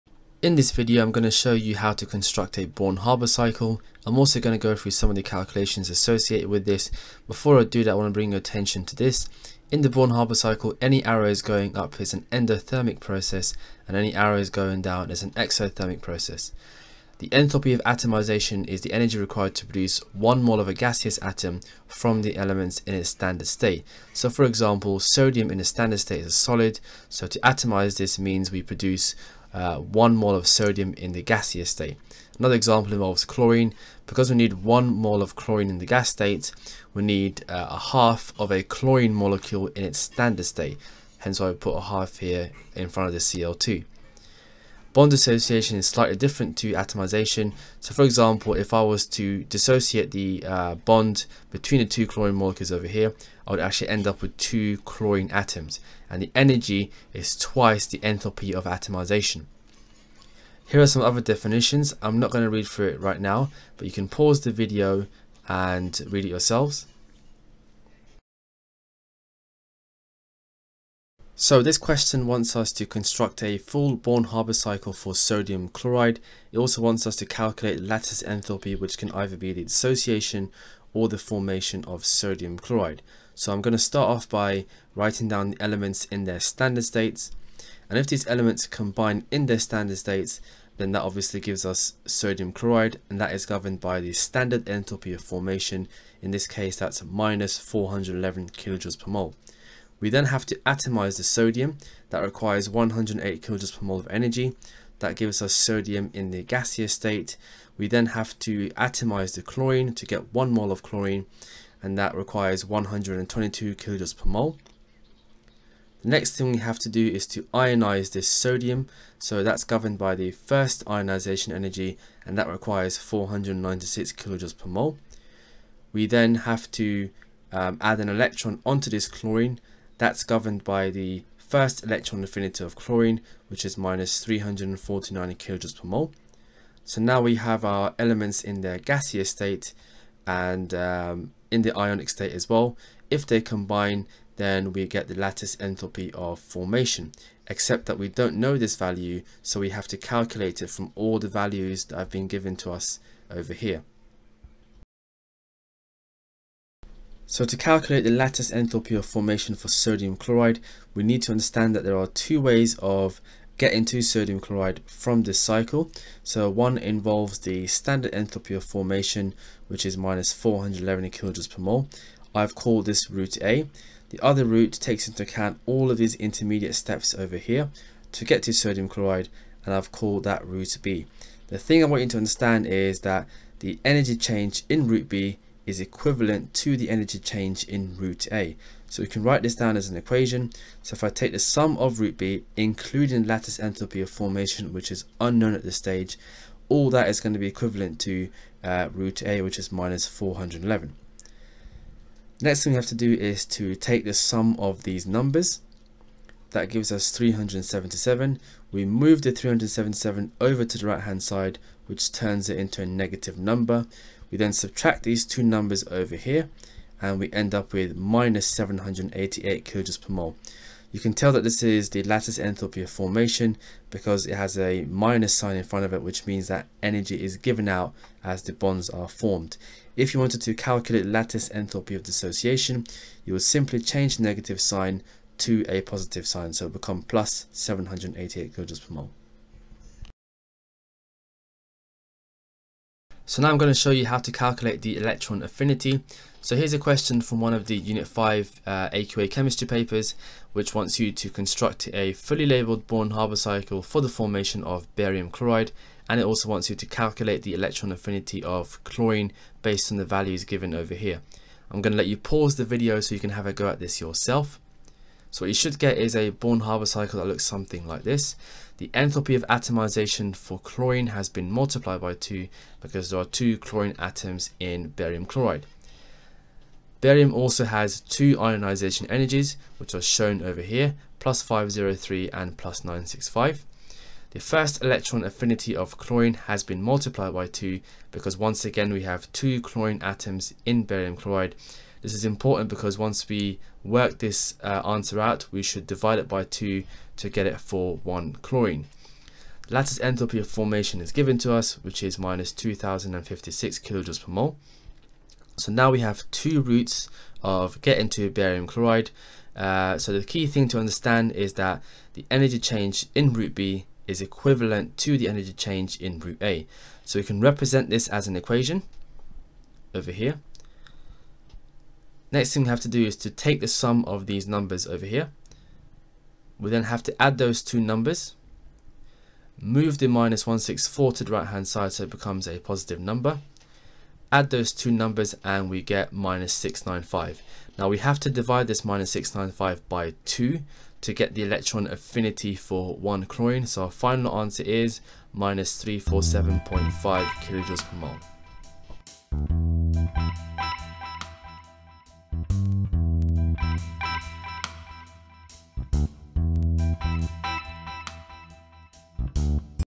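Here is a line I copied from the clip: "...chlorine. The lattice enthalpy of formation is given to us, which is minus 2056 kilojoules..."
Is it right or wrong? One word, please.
right.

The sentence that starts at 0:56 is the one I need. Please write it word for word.
And the energy is twice the enthalpy of atomization.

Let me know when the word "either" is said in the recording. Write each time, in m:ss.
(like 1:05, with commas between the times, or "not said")
1:19.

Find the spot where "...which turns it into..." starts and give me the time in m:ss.
3:31.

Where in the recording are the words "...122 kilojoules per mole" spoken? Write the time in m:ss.
1:52.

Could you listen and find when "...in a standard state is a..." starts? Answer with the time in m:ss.
0:25.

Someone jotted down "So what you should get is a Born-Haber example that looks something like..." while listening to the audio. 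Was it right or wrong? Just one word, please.
wrong.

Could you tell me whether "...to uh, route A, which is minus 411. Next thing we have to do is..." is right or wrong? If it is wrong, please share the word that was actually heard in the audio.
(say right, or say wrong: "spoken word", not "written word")
right.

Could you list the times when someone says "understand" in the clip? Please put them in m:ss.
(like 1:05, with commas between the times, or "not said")
2:41, 3:02, 5:10.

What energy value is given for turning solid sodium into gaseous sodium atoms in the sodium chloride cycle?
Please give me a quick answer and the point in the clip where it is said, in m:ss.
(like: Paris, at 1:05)
108 kJ/mol, at 1:42.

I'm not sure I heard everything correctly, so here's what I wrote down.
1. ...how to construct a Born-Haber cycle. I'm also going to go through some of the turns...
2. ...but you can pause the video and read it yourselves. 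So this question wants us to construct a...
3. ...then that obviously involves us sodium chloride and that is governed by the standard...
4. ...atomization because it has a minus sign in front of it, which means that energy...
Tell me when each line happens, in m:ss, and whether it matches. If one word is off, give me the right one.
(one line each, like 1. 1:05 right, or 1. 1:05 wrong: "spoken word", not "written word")
1. 0:01 wrong: "calculations", not "turns"
2. 1:03 right
3. 1:30 wrong: "gives", not "involves"
4. 3:42 wrong: "formation", not "atomization".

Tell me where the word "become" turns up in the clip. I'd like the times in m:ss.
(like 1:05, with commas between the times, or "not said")
3:56, 5:32.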